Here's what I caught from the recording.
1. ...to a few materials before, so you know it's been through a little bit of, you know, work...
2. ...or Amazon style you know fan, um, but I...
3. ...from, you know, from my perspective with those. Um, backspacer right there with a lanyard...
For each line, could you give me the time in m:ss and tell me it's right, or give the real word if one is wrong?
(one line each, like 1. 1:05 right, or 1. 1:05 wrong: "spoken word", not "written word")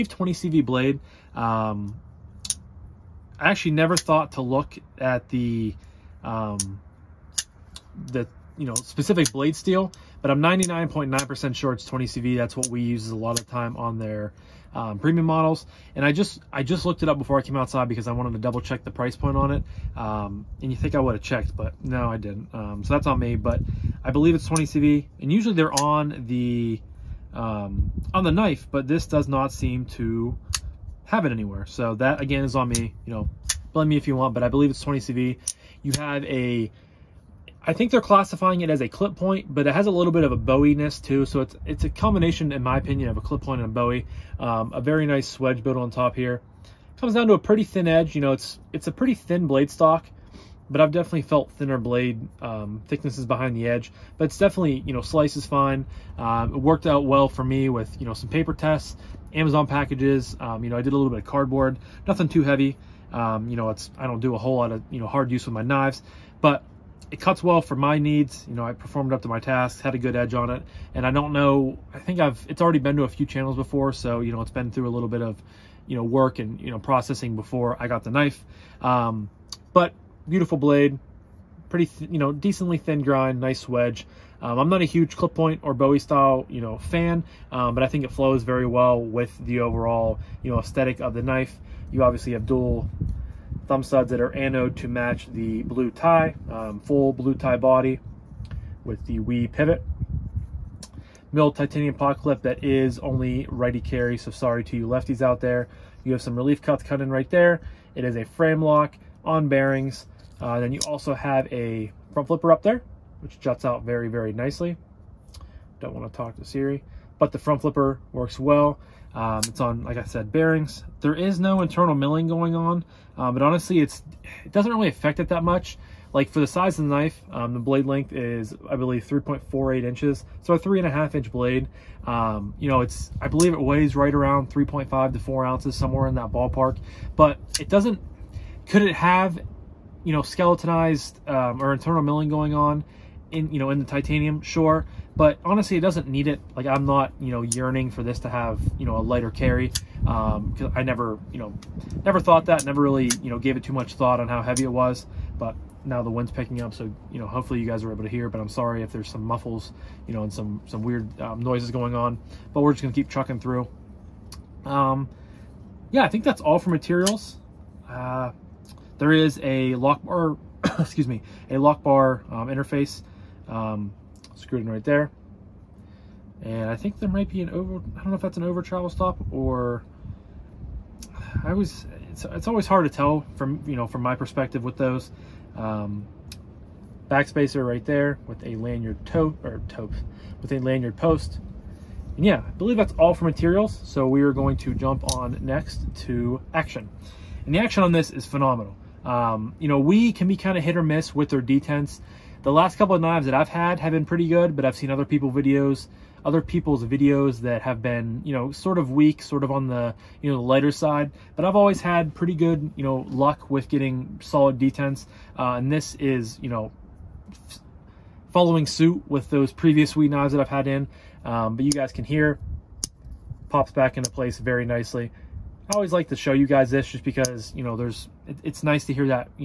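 1. 1:12 wrong: "channels", not "materials"
2. 1:25 wrong: "Bowie", not "Amazon"
3. 3:03 right.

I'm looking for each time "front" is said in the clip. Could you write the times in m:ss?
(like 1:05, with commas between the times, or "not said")
1:52, 1:57.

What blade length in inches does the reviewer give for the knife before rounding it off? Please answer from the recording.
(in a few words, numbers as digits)
3.48 inches.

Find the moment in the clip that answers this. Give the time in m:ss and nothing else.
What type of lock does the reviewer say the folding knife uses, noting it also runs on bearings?
1:48.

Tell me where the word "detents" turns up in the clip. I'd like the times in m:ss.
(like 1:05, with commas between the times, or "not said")
3:21, 3:34.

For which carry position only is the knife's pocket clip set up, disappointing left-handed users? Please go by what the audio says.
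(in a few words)
righty carry.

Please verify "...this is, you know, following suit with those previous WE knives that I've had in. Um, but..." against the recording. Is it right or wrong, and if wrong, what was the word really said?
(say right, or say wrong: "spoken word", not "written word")
right.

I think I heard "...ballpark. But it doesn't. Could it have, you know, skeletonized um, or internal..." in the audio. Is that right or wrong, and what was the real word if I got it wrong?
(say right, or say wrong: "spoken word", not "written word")
right.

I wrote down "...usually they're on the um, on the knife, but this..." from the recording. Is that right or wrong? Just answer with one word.
right.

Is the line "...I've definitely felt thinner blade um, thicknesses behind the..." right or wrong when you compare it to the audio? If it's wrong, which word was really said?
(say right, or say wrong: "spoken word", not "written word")
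right.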